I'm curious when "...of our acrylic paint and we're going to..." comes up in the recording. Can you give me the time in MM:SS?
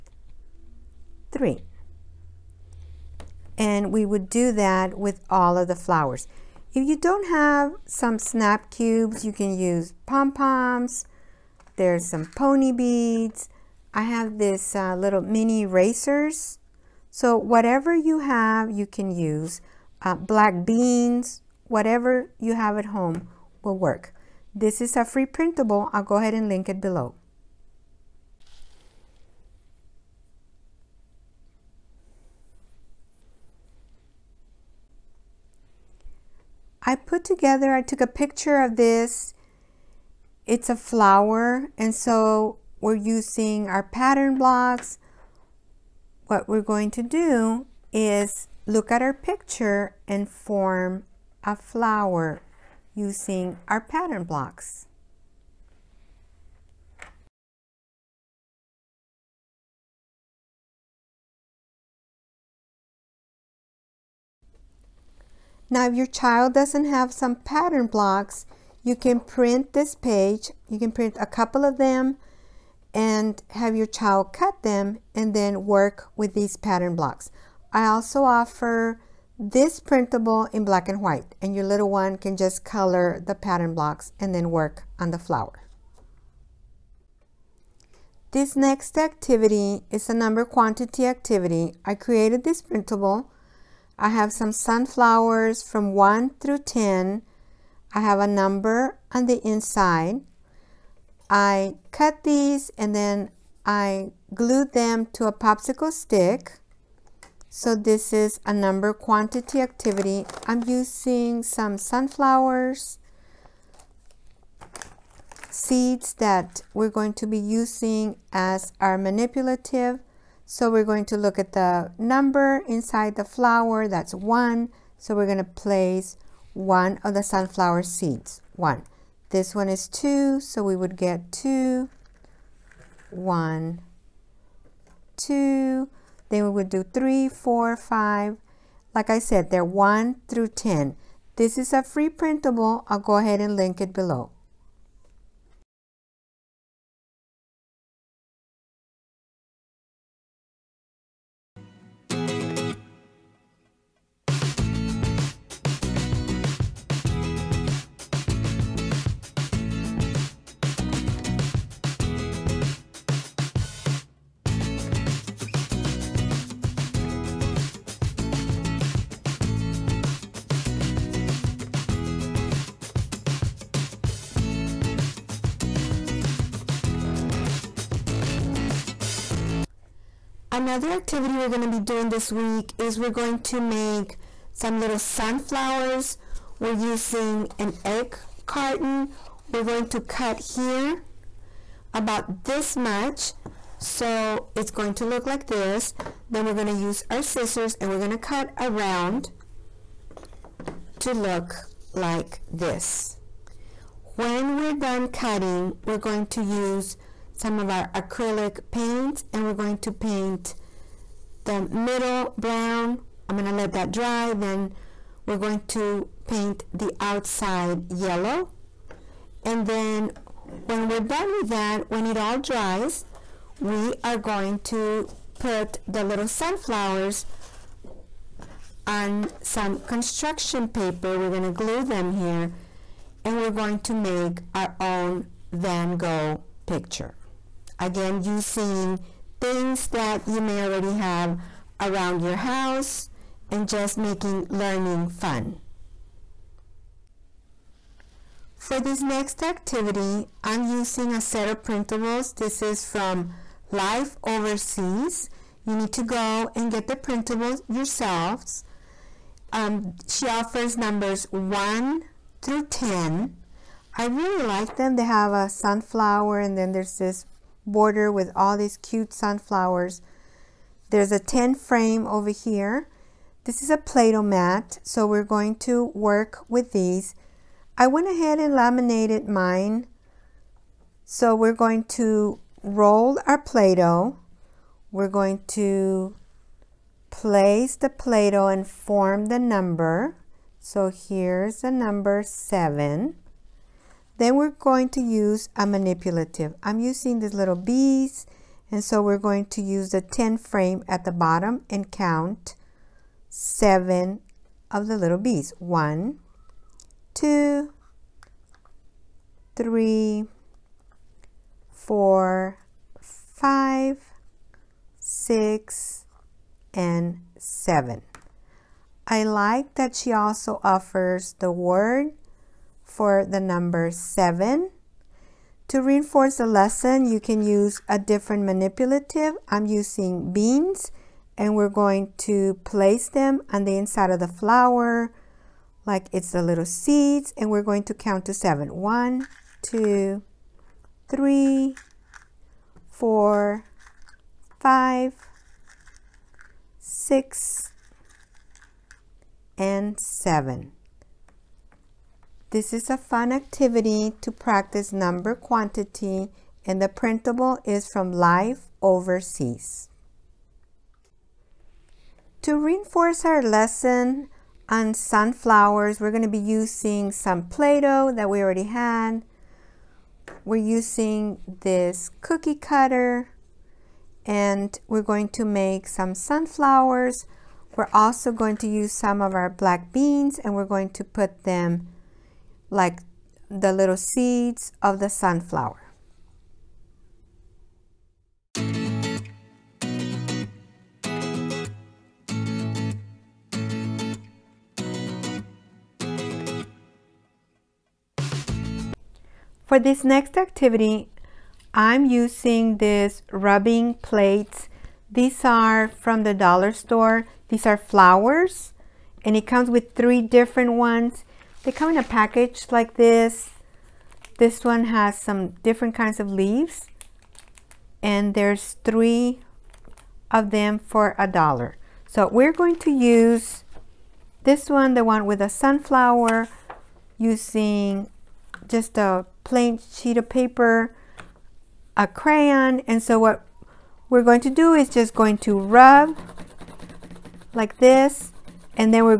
03:27.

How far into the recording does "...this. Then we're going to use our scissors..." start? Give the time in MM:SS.
03:15.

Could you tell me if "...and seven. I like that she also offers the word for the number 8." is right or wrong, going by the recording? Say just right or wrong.
wrong.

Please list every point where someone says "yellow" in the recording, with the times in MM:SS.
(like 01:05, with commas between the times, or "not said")
03:37.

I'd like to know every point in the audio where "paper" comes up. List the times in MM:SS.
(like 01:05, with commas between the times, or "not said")
03:50, 07:10.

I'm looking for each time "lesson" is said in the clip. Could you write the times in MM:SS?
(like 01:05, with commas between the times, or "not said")
05:26, 06:03.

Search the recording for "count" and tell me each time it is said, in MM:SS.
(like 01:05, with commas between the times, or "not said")
05:01, 05:37.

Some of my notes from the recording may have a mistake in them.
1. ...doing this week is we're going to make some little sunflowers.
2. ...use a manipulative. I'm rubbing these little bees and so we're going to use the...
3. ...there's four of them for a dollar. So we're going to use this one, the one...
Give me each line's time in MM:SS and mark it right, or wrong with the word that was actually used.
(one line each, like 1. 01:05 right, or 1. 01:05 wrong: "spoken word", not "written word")
1. 03:01 right
2. 04:54 wrong: "using", not "rubbing"
3. 06:58 wrong: "three", not "four".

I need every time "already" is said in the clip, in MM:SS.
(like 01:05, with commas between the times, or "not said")
04:00, 06:08.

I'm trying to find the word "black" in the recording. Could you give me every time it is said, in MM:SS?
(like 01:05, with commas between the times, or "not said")
00:20, 01:20, 06:19.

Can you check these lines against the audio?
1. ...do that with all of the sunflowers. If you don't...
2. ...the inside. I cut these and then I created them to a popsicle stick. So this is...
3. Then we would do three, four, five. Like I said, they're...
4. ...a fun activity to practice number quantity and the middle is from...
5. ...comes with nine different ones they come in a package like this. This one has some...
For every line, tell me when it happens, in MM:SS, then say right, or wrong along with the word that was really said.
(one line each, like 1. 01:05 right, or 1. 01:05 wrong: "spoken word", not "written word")
1. 00:04 wrong: "flowers", not "sunflowers"
2. 01:39 wrong: "glued", not "created"
3. 02:16 right
4. 05:52 wrong: "printable", not "middle"
5. 06:49 wrong: "three", not "nine".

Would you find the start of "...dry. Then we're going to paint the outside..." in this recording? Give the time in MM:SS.
03:33.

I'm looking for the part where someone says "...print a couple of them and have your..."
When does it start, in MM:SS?
01:10.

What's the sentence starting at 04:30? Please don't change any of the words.
There's a 10 frame over here.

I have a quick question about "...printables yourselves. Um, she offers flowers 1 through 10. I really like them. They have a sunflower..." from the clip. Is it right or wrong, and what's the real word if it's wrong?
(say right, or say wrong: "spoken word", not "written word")
wrong: "numbers", not "flowers".